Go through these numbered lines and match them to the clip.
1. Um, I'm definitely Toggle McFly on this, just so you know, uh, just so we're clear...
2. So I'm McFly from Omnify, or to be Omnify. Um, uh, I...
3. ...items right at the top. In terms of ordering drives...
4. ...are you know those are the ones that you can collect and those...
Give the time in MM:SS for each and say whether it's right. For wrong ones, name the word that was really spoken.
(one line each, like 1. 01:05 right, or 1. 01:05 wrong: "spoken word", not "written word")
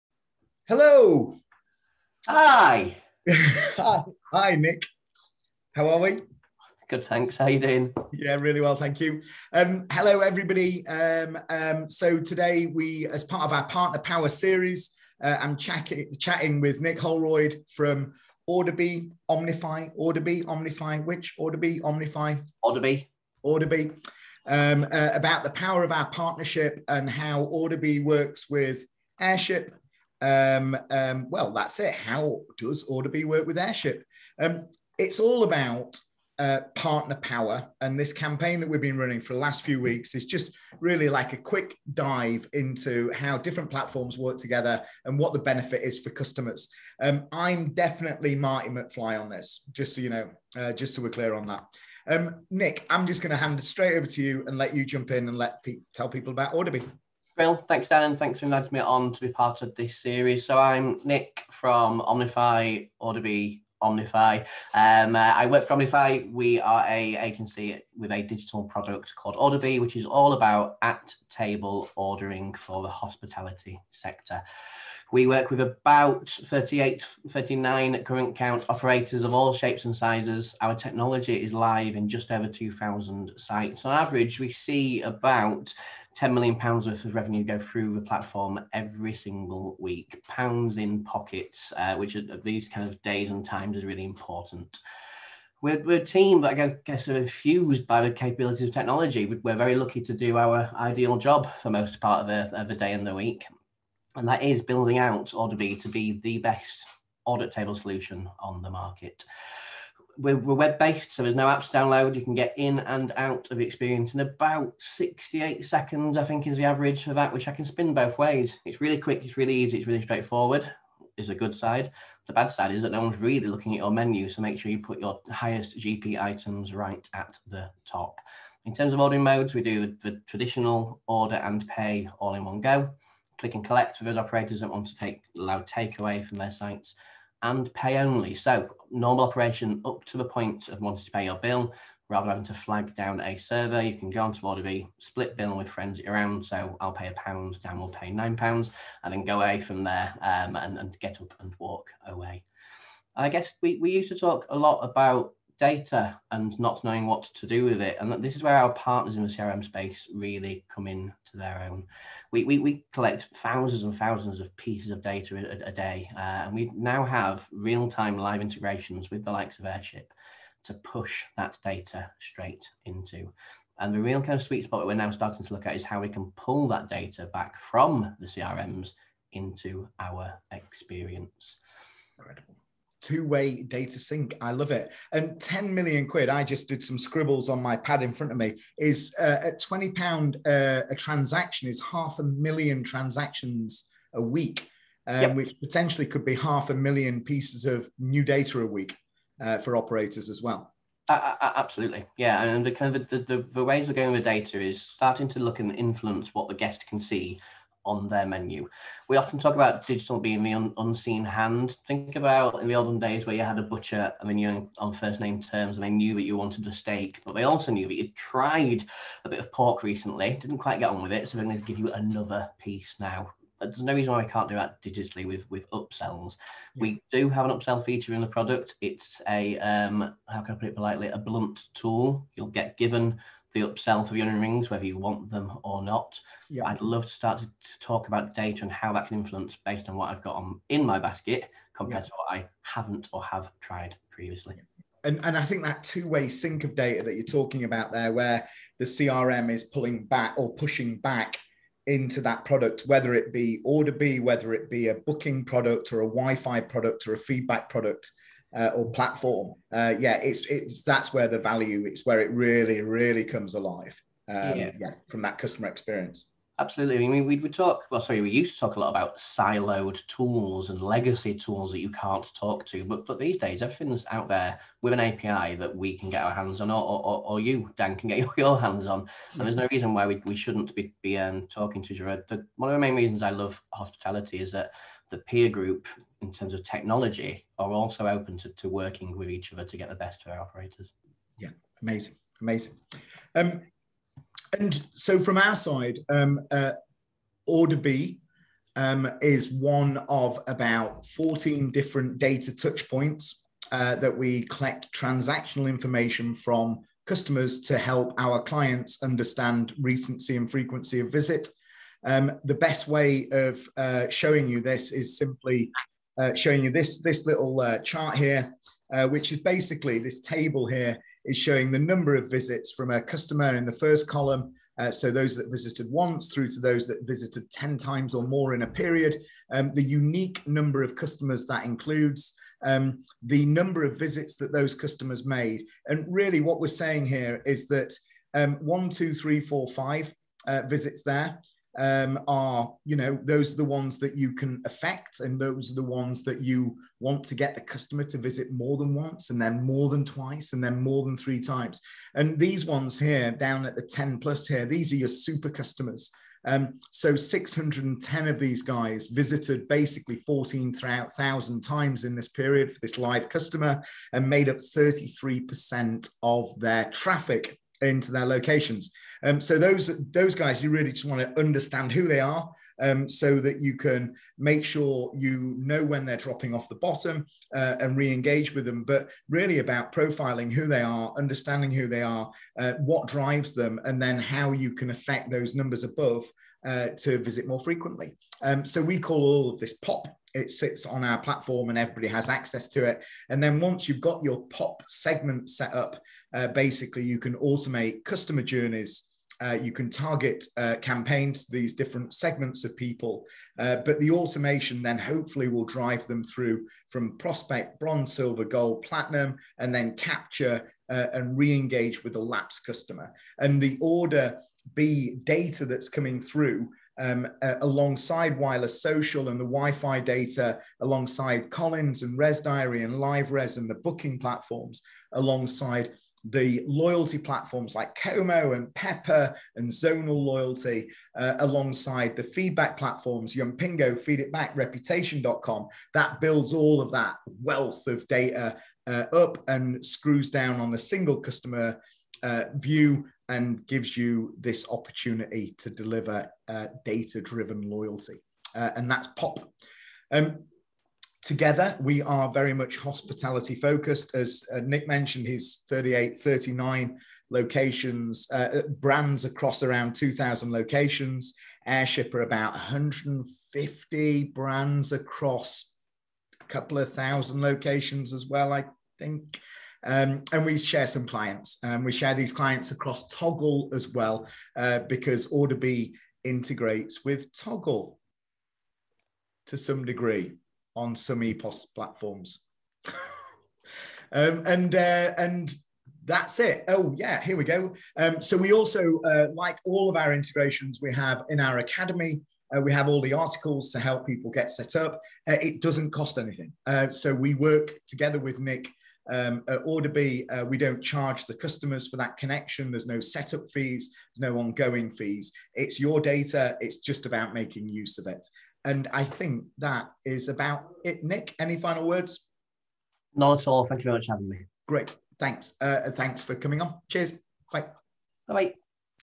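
1. 00:47 wrong: "Marty", not "Toggle"
2. 01:00 wrong: "Nick", not "McFly"
3. 02:06 wrong: "modes", not "drives"
4. 05:42 wrong: "affect", not "collect".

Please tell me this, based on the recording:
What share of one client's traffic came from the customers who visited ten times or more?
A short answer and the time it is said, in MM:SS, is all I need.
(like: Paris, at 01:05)
33%, at 06:04.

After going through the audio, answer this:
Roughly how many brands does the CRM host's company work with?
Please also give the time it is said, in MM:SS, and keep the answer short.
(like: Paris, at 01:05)
150, at 07:42.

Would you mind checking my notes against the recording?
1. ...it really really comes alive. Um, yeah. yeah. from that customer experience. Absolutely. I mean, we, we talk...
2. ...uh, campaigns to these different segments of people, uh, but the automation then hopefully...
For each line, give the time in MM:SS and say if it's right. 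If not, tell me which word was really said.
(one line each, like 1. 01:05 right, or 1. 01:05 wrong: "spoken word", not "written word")
1. 04:22 right
2. 06:40 right.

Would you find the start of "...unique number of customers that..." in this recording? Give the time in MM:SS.
05:29.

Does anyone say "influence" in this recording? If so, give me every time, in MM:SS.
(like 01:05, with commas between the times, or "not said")
03:25, 03:59.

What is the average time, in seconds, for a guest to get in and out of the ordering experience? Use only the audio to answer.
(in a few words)
68 seconds.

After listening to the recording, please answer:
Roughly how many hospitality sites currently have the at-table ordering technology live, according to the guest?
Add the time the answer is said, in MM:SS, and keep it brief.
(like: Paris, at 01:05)
just over 2,000, at 01:22.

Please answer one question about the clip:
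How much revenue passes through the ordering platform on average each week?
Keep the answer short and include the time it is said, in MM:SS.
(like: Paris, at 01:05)
10 million pounds, at 01:26.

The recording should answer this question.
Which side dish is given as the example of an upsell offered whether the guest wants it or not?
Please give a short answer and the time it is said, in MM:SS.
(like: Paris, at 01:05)
onion rings, at 03:54.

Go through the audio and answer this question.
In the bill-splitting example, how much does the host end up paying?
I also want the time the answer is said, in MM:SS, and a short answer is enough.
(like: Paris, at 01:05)
9 pounds, at 02:28.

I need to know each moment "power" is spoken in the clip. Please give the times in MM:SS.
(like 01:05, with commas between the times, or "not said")
00:13, 00:25, 00:37.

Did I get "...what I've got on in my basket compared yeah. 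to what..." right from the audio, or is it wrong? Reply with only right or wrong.
right.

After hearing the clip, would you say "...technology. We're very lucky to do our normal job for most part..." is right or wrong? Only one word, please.
wrong.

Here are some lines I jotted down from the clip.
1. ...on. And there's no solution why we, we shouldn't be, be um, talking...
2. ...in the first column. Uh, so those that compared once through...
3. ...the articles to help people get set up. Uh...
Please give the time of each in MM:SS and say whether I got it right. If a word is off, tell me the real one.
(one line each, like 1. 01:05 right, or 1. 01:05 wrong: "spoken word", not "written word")
1. 04:38 wrong: "reason", not "solution"
2. 05:23 wrong: "visited", not "compared"
3. 08:13 right.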